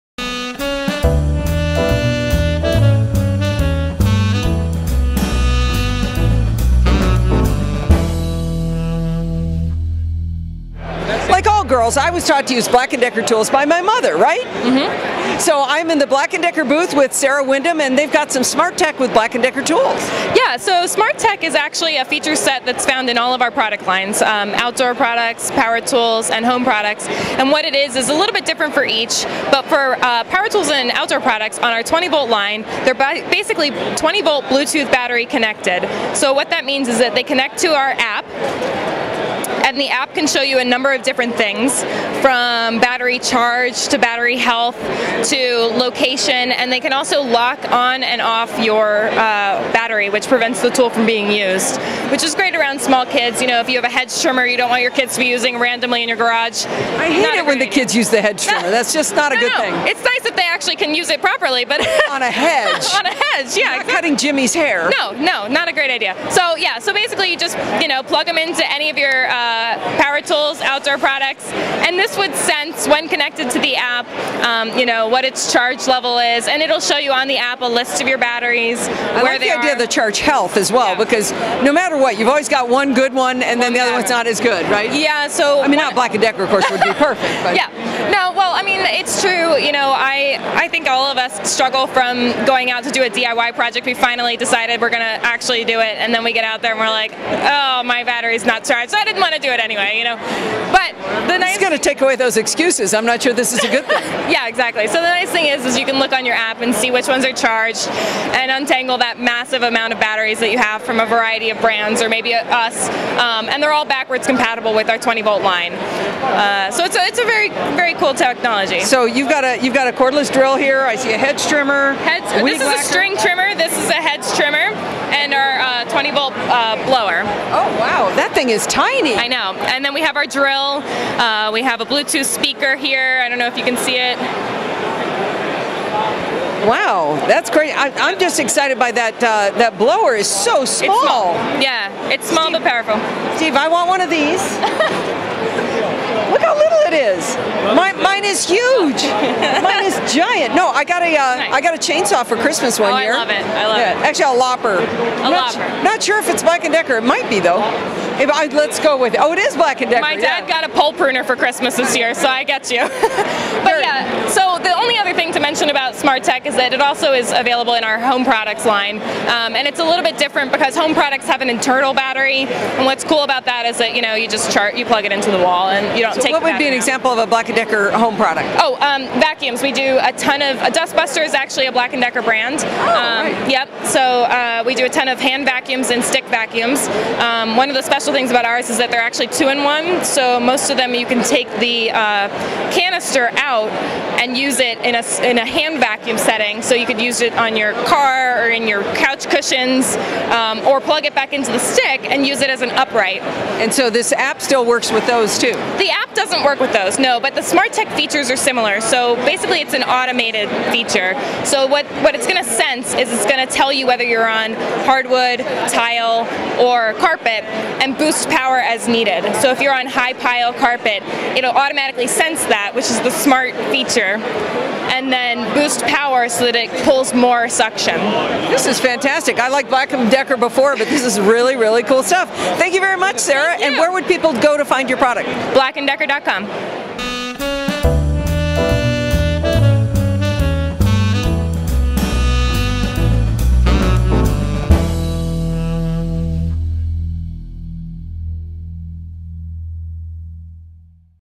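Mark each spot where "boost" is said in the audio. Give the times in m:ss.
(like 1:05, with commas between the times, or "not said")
3:37, 3:45.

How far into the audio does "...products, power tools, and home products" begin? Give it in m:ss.
0:24.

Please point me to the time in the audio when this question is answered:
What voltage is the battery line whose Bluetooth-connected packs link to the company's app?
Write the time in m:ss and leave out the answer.
0:33.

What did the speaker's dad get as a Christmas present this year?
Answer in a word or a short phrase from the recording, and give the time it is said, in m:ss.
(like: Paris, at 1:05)
A pole pruner, at 2:40.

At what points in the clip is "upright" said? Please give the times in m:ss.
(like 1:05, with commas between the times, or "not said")
3:22.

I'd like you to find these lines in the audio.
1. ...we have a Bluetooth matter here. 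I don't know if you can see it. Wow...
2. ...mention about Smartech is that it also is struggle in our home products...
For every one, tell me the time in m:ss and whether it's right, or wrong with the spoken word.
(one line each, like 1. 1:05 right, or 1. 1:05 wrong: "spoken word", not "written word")
1. 2:11 wrong: "speaker", not "matter"
2. 2:45 wrong: "available", not "struggle".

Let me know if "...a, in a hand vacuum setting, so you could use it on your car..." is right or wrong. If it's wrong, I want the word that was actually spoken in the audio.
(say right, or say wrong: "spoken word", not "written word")
right.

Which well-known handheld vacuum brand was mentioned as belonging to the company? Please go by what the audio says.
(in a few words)
Dustbuster.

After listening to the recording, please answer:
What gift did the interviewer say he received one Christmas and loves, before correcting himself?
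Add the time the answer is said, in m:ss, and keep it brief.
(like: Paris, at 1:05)
A chainsaw, at 2:31.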